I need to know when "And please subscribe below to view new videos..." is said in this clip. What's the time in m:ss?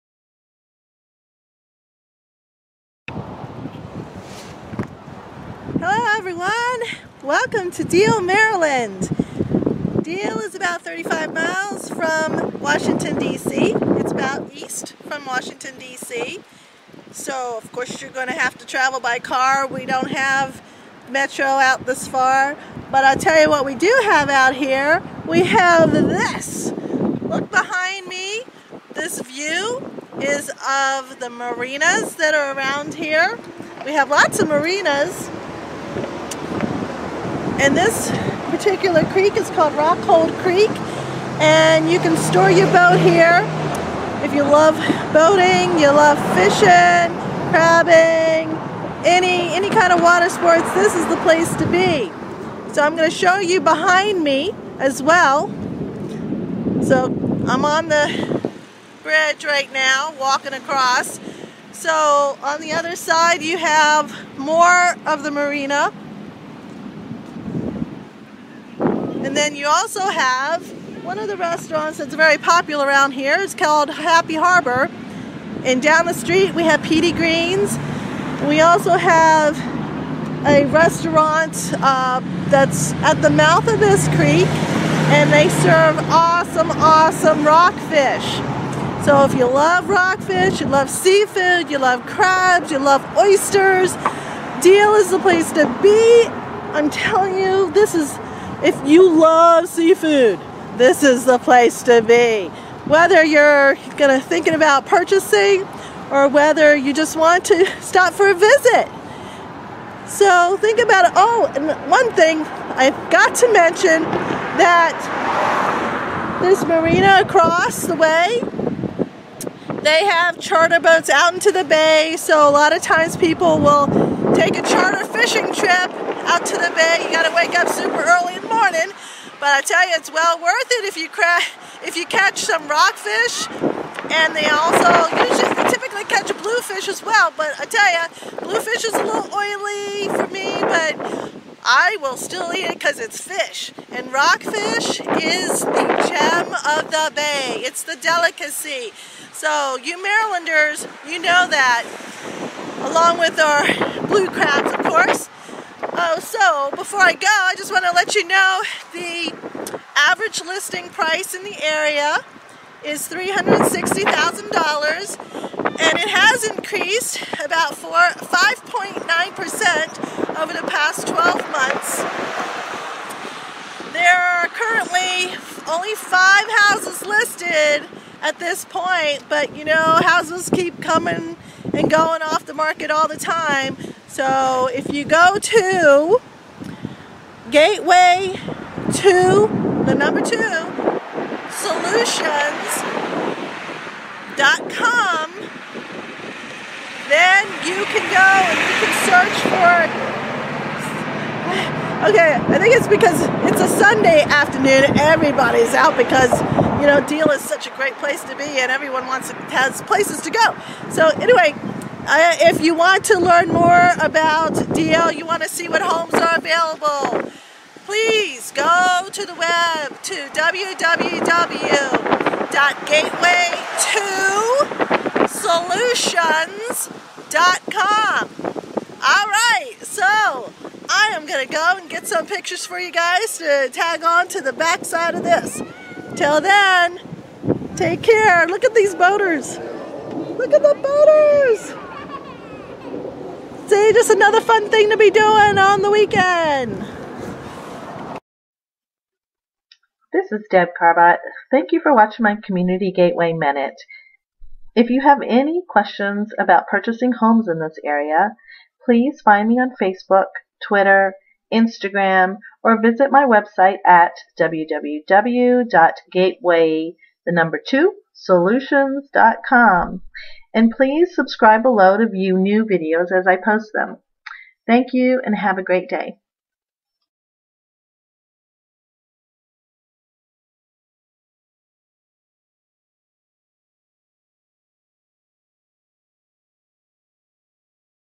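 4:30.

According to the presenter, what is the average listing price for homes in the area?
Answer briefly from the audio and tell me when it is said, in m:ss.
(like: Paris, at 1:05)
$360,000, at 2:43.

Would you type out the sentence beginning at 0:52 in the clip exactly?
So I'm going to show you behind me as well.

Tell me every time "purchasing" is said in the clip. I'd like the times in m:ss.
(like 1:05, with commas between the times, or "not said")
1:44, 4:16.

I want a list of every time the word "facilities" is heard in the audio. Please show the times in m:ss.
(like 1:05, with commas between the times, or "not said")
not said.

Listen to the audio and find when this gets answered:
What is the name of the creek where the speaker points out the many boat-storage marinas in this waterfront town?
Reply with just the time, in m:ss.
0:39.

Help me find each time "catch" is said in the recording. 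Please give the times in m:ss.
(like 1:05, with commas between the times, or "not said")
2:12, 2:16.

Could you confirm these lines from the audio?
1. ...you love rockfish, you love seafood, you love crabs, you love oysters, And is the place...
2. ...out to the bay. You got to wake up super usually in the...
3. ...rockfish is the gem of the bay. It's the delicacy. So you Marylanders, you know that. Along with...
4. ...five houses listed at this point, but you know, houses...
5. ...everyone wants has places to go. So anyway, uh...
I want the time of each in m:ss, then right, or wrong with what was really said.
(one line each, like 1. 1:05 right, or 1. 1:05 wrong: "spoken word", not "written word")
1. 1:29 wrong: "Deale", not "And"
2. 2:06 wrong: "early", not "usually"
3. 2:24 right
4. 2:55 right
5. 3:28 right.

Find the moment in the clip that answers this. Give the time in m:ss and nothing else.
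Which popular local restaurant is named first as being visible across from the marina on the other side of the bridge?
1:13.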